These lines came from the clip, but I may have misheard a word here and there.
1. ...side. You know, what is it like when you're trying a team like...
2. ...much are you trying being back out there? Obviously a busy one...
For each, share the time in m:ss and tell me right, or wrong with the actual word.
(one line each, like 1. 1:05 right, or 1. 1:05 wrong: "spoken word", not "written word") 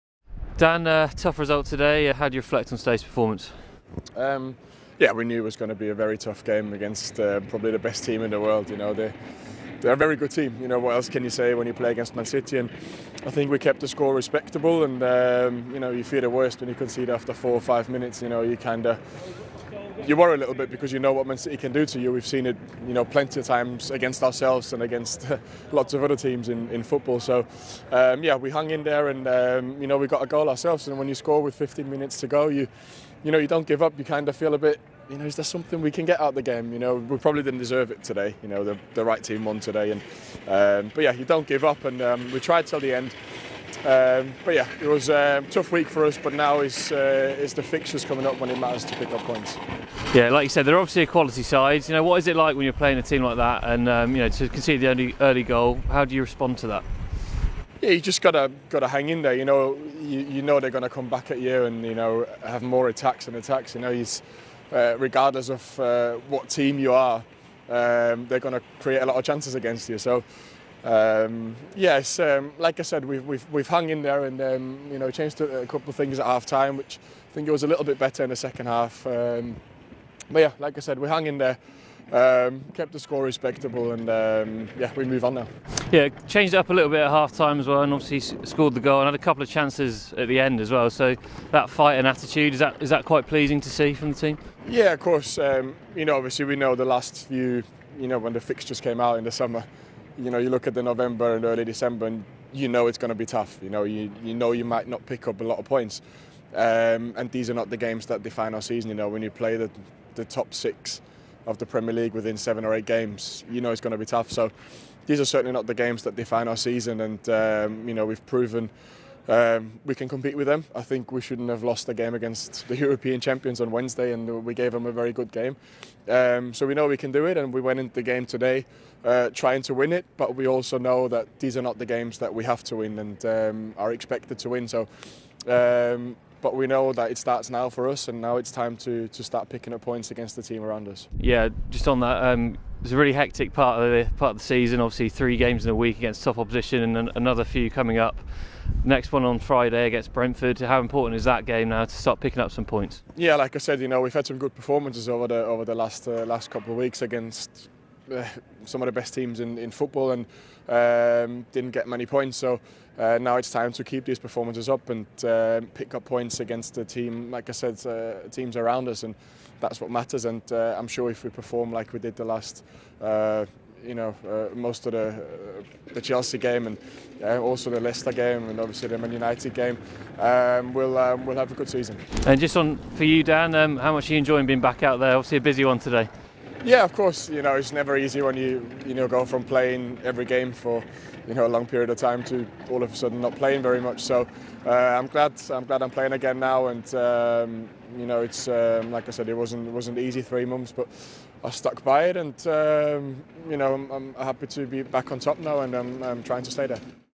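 1. 0:51 wrong: "playing", not "trying"
2. 3:03 wrong: "enjoying", not "trying".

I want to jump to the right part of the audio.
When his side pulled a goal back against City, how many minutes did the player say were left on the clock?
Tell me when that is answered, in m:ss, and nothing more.
0:31.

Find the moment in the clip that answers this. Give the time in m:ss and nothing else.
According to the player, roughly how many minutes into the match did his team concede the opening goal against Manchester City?
0:17.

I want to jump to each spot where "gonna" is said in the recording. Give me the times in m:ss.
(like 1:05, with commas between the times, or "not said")
1:00, 1:08.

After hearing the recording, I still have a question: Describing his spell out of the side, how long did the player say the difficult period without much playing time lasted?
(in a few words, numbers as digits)
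3 months.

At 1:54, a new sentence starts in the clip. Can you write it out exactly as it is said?
So these are certainly not the games that define our season.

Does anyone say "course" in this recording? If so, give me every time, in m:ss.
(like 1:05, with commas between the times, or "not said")
1:34, 3:06.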